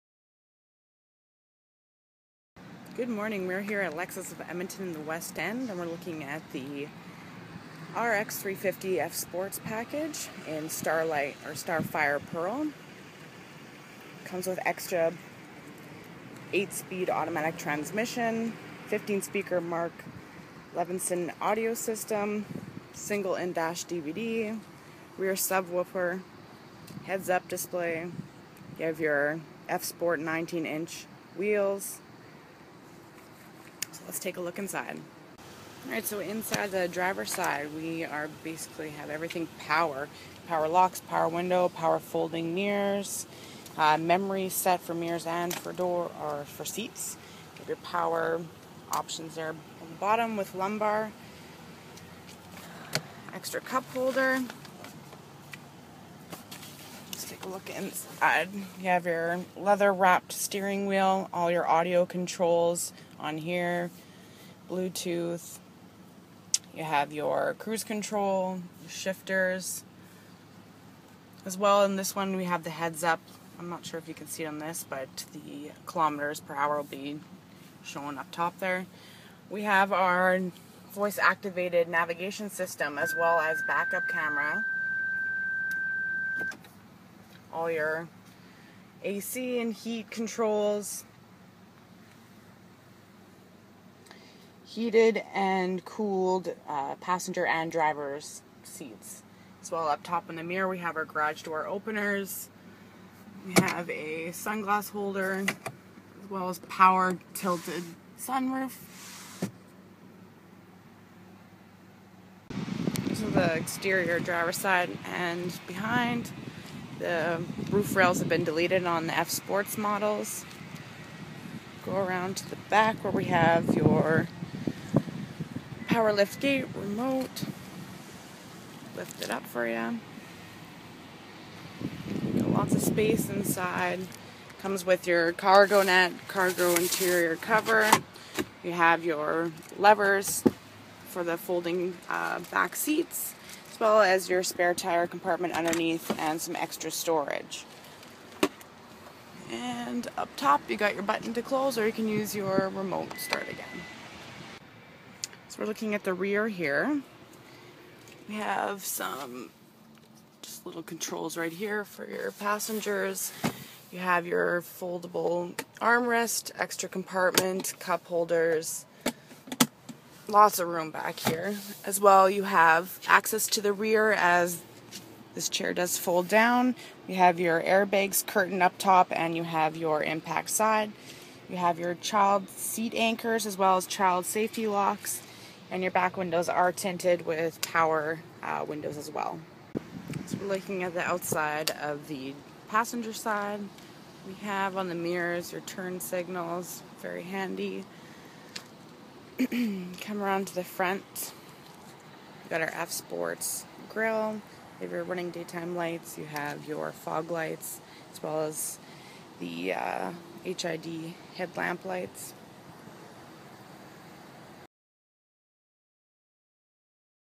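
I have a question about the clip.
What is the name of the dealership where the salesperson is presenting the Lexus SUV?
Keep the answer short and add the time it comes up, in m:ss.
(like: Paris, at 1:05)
Lexus of Edmonton, at 0:03.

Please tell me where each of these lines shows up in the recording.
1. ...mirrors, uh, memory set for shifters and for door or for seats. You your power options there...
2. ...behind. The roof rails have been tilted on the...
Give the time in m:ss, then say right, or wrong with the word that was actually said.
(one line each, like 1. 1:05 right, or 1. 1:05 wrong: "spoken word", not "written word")
1. 0:42 wrong: "mirrors", not "shifters"
2. 1:55 wrong: "deleted", not "tilted".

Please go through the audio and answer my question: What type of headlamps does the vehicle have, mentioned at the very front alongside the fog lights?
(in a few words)
HID.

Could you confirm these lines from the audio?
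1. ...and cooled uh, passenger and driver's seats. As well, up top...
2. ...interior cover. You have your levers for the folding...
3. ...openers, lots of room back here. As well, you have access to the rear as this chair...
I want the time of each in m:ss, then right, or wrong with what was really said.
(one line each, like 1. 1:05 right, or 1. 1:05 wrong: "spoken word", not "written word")
1. 1:35 right
2. 2:16 right
3. 2:48 wrong: "holders", not "openers".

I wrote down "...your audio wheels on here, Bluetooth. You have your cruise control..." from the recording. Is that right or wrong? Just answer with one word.
wrong.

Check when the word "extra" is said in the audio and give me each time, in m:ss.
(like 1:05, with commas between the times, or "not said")
0:14, 0:53, 2:26, 2:46.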